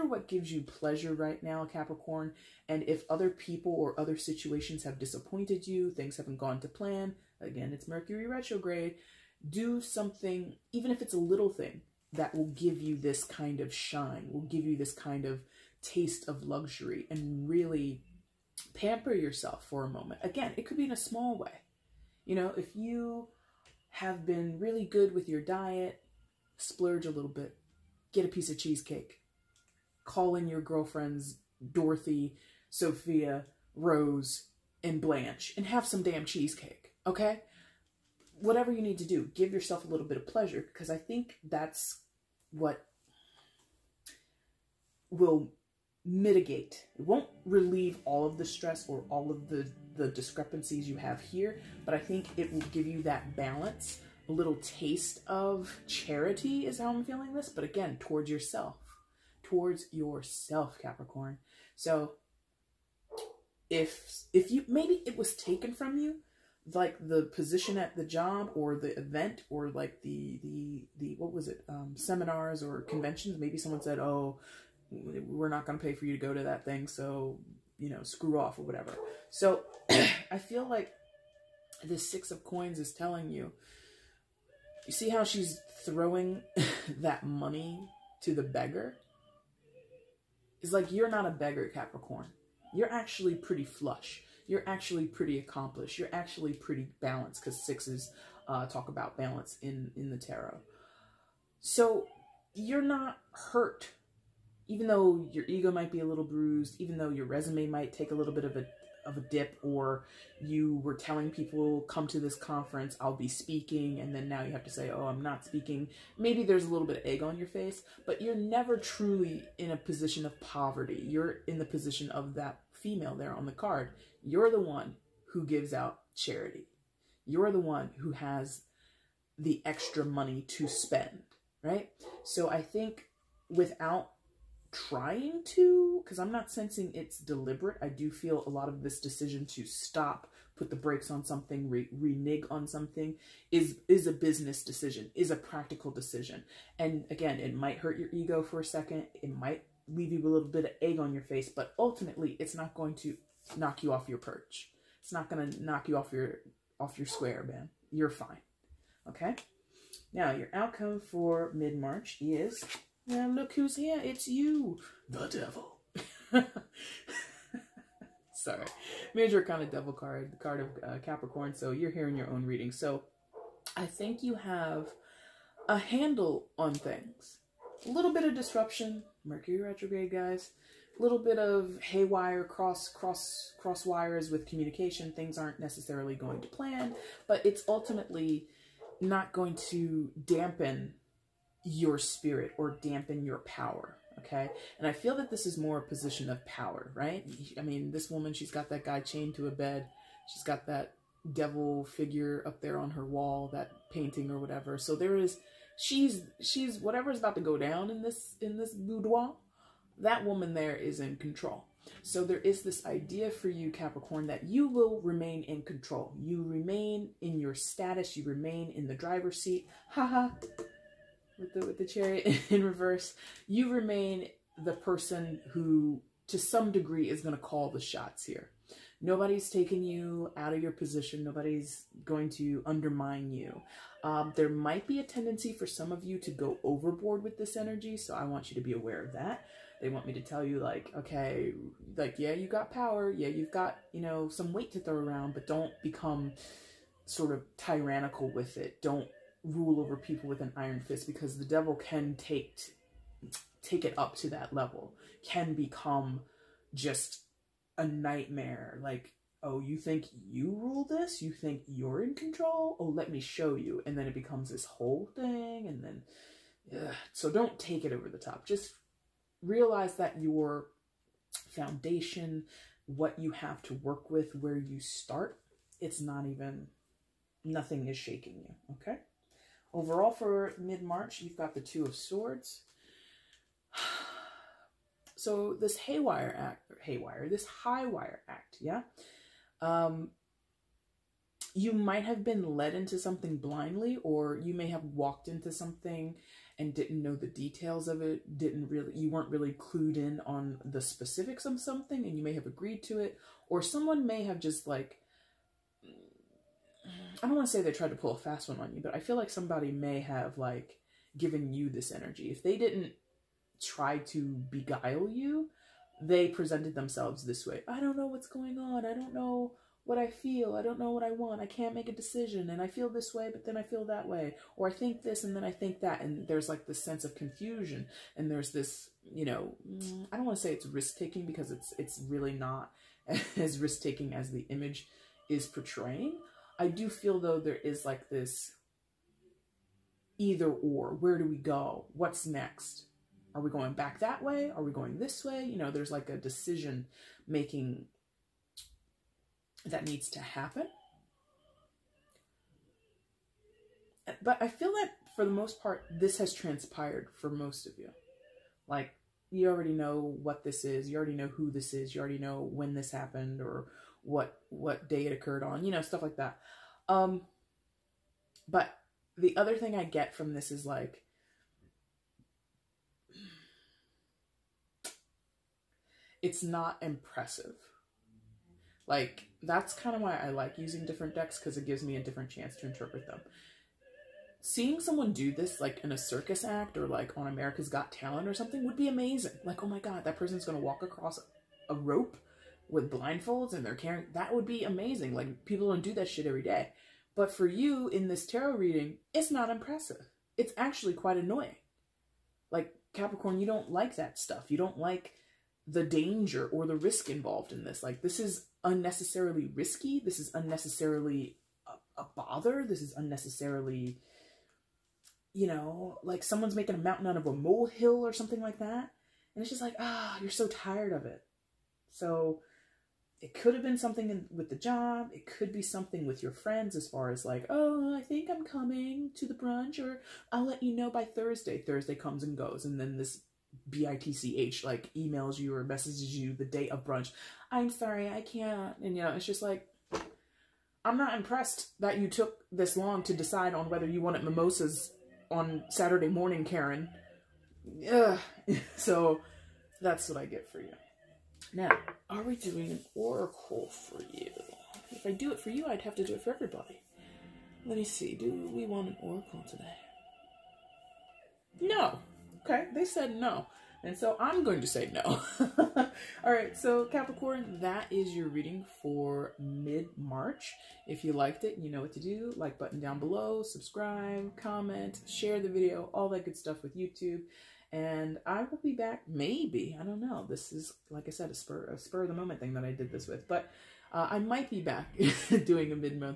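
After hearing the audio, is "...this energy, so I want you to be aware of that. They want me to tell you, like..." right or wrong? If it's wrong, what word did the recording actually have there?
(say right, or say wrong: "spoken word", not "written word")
right.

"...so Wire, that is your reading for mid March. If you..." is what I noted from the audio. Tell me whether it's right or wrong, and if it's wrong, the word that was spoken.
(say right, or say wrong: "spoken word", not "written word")
wrong: "Capricorn", not "Wire".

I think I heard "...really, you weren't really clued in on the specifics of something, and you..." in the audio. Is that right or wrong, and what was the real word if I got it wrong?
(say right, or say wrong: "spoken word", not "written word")
right.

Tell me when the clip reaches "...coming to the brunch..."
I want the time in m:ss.
7:08.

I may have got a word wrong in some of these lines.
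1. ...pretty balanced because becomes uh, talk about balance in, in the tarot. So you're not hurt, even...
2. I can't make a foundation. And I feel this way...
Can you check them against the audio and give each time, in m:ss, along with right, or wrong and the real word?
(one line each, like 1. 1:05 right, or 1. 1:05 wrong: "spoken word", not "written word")
1. 1:36 wrong: "sixes", not "becomes"
2. 5:21 wrong: "decision", not "foundation".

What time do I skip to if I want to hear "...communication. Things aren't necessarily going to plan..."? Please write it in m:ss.
3:04.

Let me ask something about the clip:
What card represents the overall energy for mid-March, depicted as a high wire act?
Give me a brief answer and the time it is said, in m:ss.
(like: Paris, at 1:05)
Two of Swords, at 4:41.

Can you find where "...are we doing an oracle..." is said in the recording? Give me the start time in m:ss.
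7:32.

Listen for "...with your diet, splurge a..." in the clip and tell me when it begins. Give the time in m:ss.
0:25.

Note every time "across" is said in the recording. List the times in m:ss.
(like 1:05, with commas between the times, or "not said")
6:30.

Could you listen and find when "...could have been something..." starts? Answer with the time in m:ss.
7:03.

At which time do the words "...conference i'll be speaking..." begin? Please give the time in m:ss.
1:52.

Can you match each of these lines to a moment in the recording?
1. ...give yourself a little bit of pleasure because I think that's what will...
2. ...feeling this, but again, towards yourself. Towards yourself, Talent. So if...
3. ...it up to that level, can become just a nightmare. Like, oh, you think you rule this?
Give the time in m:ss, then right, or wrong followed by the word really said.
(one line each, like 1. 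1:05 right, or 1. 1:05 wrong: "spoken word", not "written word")
1. 0:39 right
2. 0:57 wrong: "Capricorn", not "Talent"
3. 4:13 right.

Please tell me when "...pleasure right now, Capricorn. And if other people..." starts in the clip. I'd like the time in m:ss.
0:00.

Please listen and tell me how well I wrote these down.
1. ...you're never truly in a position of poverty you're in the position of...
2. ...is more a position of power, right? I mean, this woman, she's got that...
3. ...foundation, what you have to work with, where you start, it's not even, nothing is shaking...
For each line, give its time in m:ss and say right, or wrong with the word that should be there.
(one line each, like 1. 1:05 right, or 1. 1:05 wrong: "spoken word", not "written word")
1. 1:58 right
2. 3:15 right
3. 4:31 right.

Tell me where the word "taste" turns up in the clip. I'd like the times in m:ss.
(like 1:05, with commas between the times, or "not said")
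0:15, 0:54.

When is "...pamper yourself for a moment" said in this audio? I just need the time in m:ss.
0:18.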